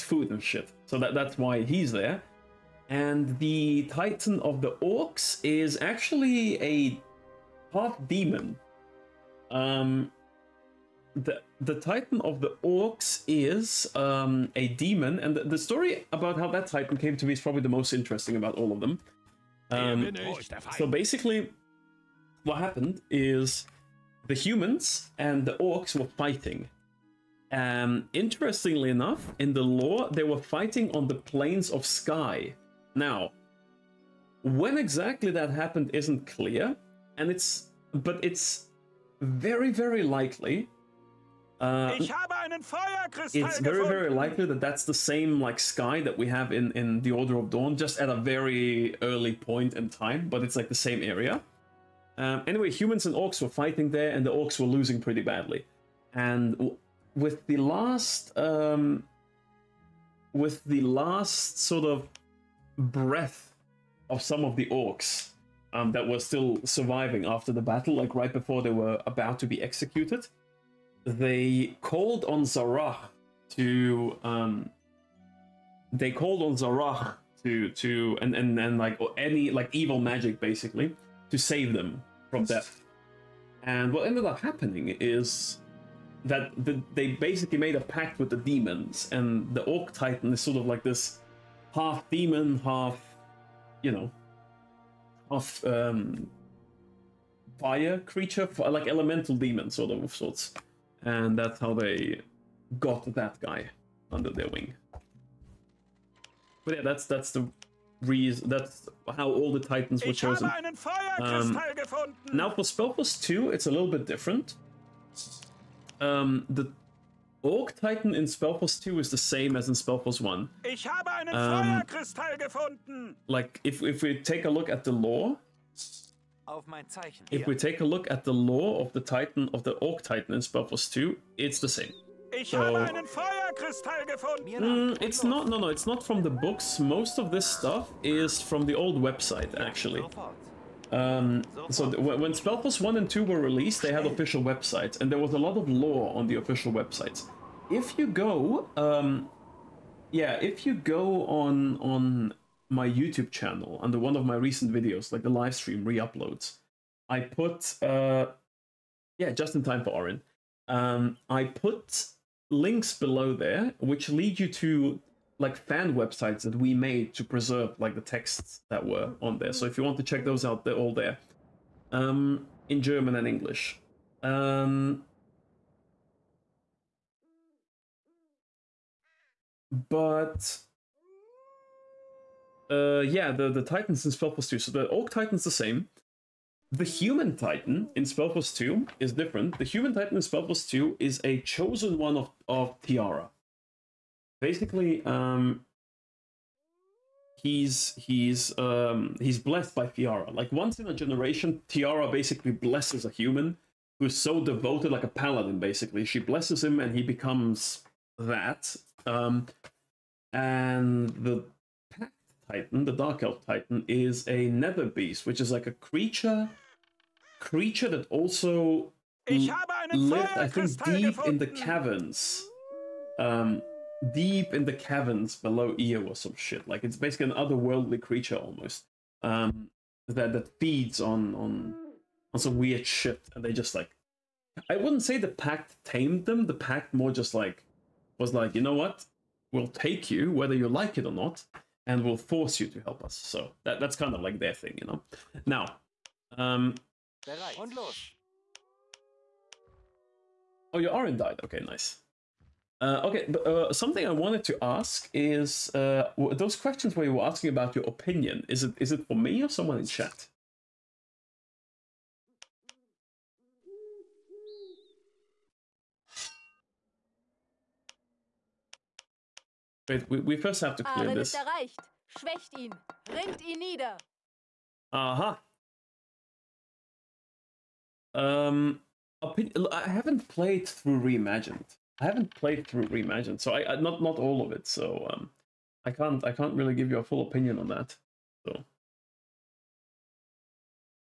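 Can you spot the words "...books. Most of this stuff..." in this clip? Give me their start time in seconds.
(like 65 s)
136 s.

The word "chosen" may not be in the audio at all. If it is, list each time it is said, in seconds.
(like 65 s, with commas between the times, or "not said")
110 s, 191 s.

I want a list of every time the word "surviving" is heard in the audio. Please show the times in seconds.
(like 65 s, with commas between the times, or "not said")
66 s.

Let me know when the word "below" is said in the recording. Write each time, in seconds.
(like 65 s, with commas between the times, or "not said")
162 s, 225 s.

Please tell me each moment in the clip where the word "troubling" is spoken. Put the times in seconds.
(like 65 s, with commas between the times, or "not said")
not said.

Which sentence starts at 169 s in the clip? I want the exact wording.
So if you want to check those out, they're all there.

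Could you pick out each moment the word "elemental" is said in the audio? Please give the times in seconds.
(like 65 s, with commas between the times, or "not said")
98 s.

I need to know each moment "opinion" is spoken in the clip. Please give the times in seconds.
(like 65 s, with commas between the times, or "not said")
257 s, 287 s.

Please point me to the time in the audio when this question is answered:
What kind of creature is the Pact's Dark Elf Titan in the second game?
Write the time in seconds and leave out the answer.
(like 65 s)
214 s.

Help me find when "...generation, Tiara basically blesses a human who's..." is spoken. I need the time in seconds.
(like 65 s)
200 s.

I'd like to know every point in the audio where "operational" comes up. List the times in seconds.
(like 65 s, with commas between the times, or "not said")
not said.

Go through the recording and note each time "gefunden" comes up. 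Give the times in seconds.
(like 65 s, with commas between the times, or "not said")
122 s, 134 s.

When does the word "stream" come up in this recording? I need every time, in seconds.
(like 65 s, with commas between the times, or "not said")
155 s.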